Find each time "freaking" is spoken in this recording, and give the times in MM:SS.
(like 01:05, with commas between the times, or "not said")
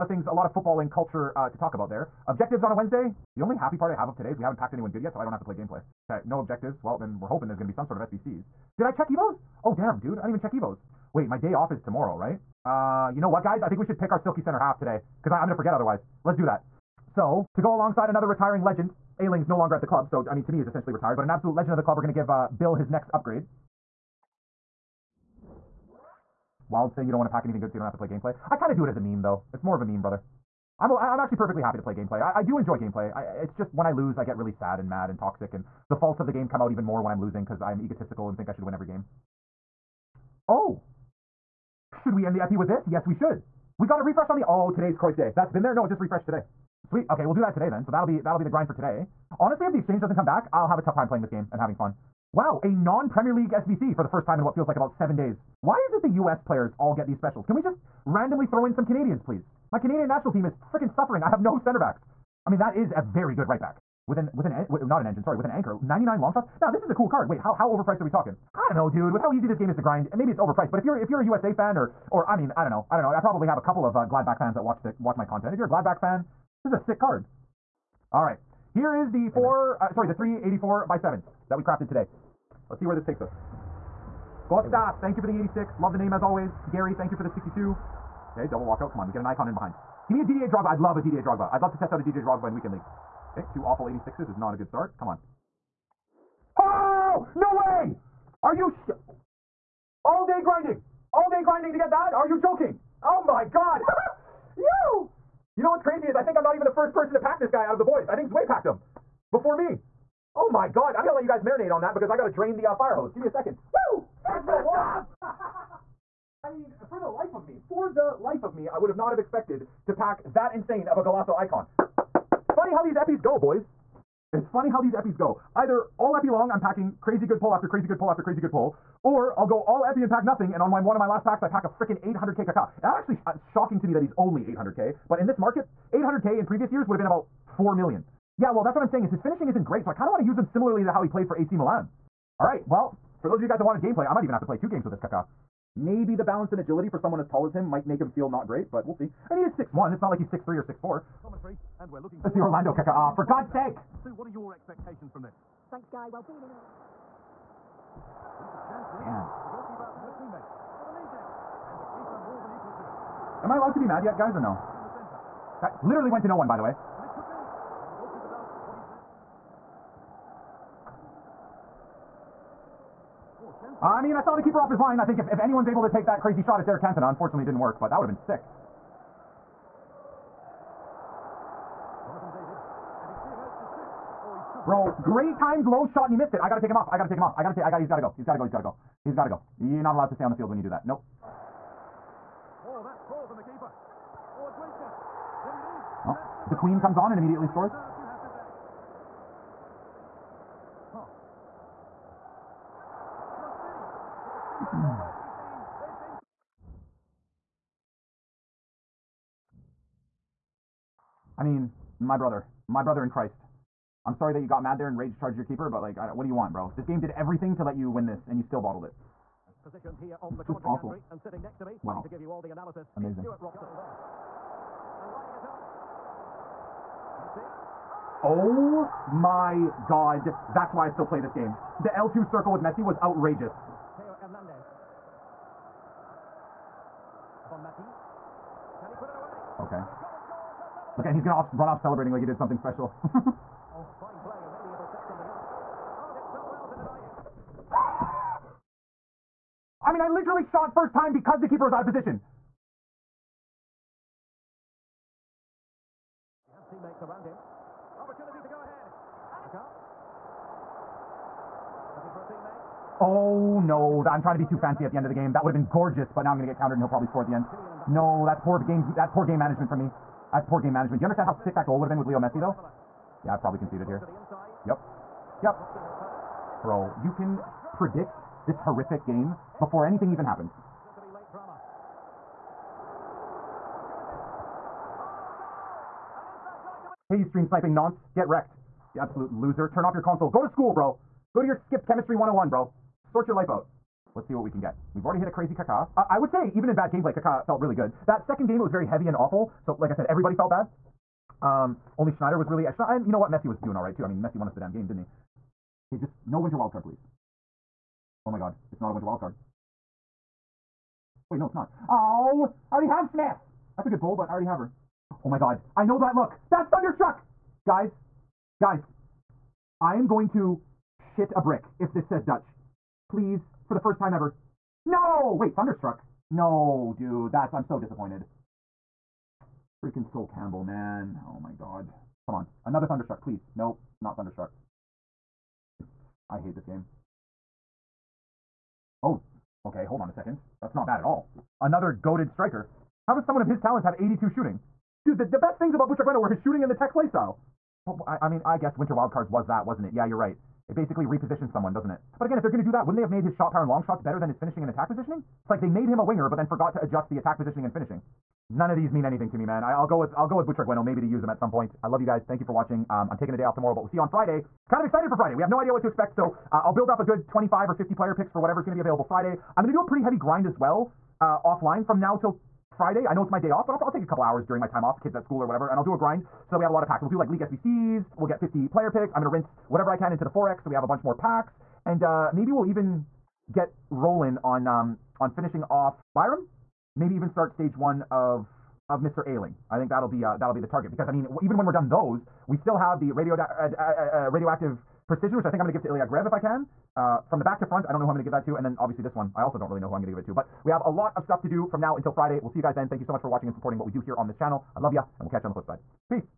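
01:00, 02:11, 05:29.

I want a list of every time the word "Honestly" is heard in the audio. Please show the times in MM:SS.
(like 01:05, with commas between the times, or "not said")
00:49.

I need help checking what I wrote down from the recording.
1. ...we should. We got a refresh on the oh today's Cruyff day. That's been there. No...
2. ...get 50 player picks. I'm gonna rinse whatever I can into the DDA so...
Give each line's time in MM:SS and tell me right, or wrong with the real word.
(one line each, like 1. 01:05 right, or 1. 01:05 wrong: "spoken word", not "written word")
1. 00:43 right
2. 06:18 wrong: "Forex", not "DDA".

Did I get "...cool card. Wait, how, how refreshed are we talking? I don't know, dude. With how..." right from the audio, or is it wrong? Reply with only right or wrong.
wrong.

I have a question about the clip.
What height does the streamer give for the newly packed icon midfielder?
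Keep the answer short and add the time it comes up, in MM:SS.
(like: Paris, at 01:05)
6'1", at 02:29.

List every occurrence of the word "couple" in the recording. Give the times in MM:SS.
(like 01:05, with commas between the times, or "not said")
01:13, 06:14.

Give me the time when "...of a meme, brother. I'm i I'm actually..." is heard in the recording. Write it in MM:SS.
00:29.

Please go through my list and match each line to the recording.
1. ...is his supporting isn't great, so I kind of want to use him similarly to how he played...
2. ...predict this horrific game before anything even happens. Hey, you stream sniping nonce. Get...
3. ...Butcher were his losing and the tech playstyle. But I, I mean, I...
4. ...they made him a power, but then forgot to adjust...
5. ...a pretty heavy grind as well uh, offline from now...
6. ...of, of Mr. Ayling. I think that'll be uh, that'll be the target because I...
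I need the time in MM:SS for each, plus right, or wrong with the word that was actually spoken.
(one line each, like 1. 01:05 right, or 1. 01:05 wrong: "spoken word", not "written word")
1. 02:19 wrong: "finishing", not "supporting"
2. 04:37 right
3. 05:45 wrong: "shooting", not "losing"
4. 05:55 wrong: "winger", not "power"
5. 06:09 right
6. 06:28 right.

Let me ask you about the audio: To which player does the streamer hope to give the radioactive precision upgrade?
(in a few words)
Ilya Gruev.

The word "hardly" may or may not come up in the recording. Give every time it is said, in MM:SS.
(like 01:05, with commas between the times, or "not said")
not said.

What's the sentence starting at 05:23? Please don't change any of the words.
Please, for the first time ever, no!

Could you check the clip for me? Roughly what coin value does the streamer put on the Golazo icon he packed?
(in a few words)
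800k.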